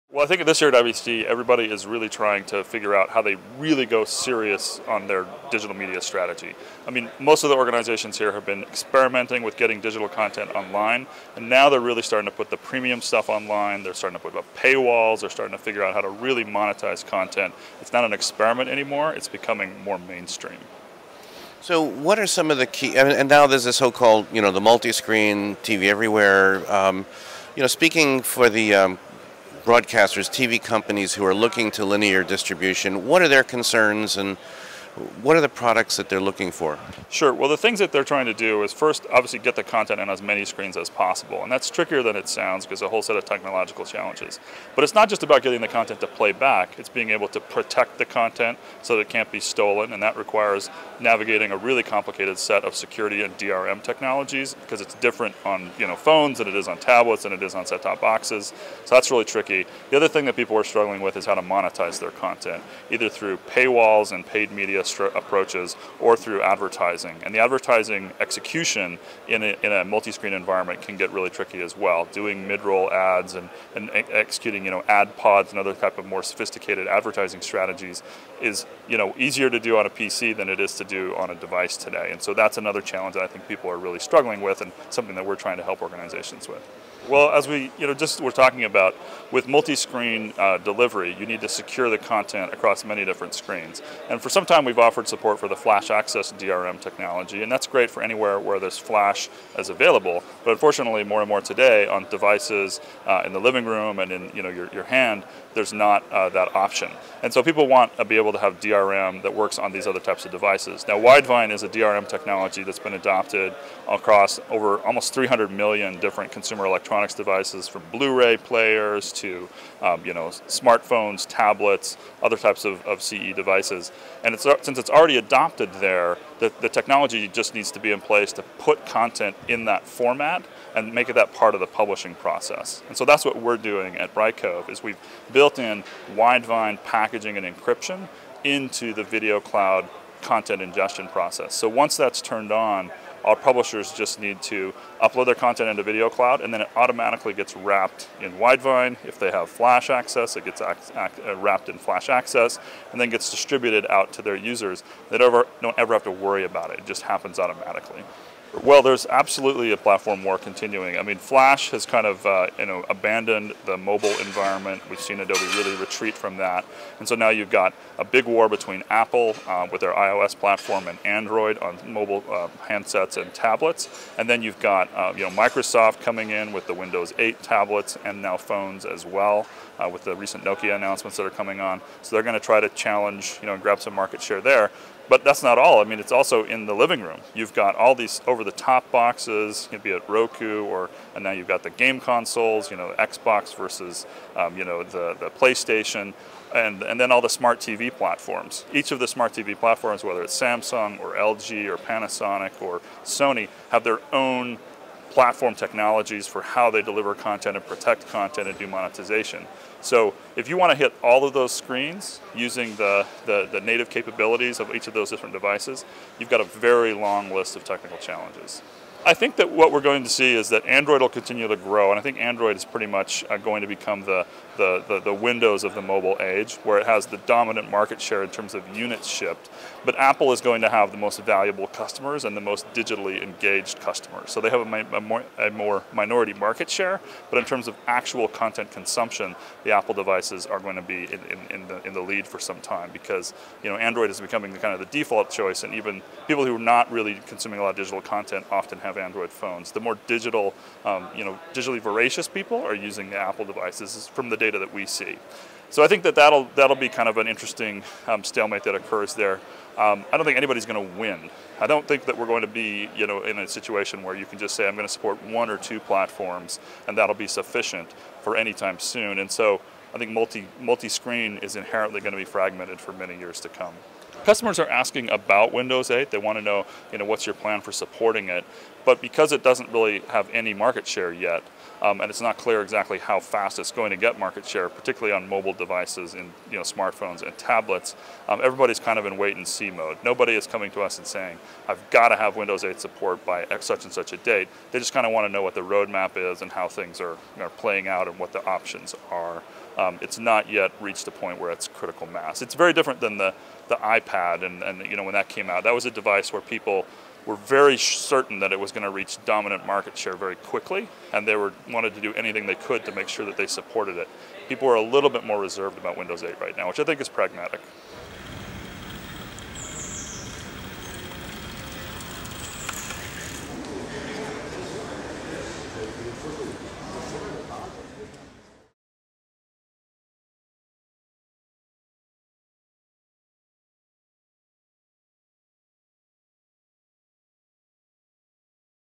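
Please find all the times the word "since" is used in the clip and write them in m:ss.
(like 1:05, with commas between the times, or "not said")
2:04.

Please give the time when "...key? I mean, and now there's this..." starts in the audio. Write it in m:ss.
0:22.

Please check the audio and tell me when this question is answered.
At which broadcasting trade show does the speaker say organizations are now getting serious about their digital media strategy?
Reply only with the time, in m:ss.
0:00.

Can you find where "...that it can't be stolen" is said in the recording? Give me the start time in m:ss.
0:48.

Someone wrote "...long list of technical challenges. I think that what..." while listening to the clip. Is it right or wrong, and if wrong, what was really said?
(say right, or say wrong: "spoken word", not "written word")
right.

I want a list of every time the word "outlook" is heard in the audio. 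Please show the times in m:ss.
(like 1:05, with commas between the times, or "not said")
not said.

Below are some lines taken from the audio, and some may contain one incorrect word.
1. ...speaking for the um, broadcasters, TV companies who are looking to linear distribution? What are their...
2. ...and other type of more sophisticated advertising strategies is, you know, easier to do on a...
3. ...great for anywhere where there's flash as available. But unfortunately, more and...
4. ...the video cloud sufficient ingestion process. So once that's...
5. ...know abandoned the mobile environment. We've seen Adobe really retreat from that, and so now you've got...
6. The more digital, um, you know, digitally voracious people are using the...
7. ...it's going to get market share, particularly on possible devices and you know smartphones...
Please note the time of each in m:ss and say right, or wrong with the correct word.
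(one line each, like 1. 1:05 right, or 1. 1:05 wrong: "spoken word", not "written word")
1. 0:27 right
2. 1:15 right
3. 1:37 right
4. 2:18 wrong: "content", not "sufficient"
5. 2:42 right
6. 4:09 right
7. 4:43 wrong: "mobile", not "possible".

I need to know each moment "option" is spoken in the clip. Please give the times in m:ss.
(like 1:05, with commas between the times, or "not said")
1:46, 4:58.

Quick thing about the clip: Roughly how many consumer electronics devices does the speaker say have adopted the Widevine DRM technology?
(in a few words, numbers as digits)
300 million.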